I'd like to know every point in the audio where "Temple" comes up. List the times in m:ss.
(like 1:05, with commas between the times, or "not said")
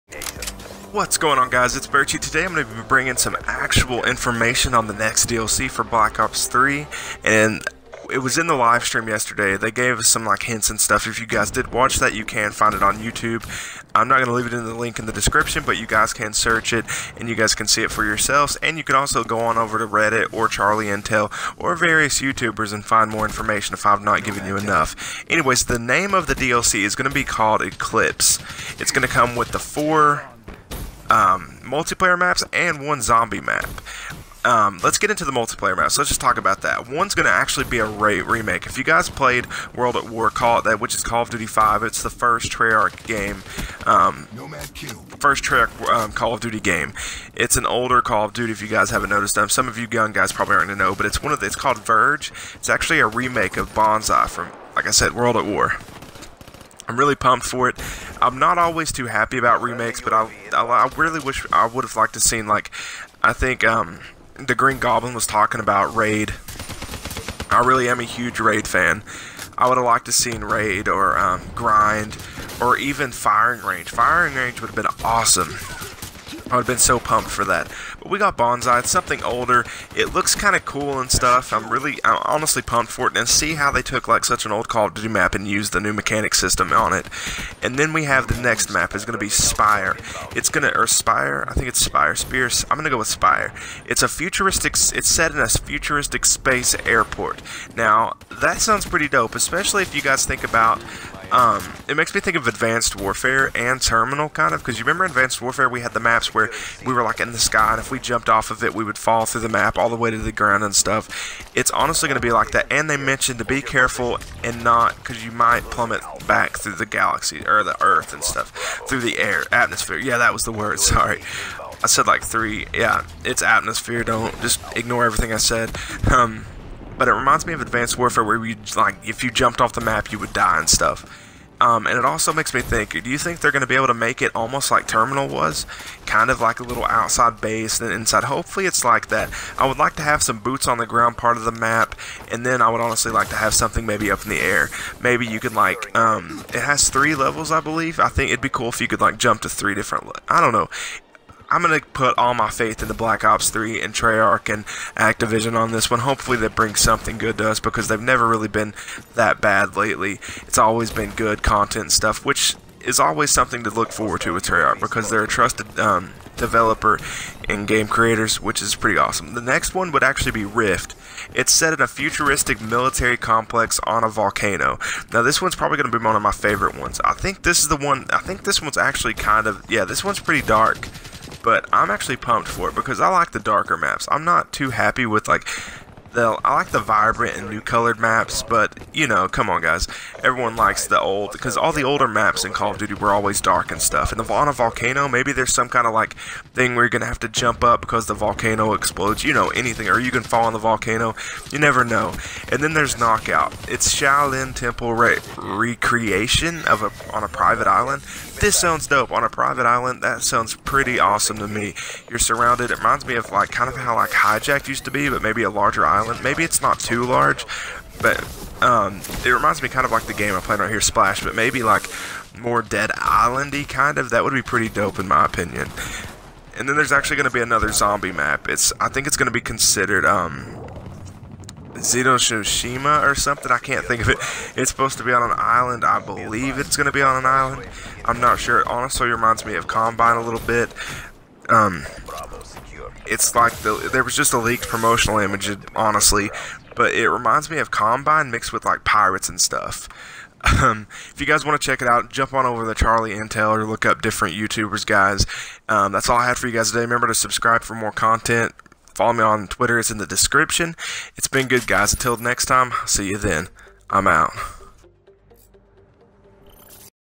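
3:24.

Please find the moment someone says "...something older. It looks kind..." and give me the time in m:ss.
1:18.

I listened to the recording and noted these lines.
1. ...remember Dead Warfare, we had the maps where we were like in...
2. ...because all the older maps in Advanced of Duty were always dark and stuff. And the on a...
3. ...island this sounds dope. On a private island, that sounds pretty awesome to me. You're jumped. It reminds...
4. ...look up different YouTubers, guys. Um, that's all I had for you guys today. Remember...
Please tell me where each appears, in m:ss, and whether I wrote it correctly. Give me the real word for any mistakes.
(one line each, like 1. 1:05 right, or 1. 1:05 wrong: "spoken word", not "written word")
1. 1:44 wrong: "Advanced", not "Dead"
2. 3:11 wrong: "Call", not "Advanced"
3. 3:27 wrong: "surrounded", not "jumped"
4. 4:13 right.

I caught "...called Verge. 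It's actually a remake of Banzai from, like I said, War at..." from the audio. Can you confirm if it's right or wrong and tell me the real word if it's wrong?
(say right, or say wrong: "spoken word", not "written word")
wrong: "World", not "War".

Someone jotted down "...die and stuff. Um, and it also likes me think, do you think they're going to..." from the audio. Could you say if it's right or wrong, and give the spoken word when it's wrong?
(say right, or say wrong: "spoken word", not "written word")
wrong: "makes", not "likes".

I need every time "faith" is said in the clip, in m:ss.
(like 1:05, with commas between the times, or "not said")
2:32.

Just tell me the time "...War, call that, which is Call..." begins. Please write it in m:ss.
0:40.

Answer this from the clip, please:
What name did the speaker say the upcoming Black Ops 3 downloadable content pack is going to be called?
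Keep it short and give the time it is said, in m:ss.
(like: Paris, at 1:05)
Eclipse, at 0:27.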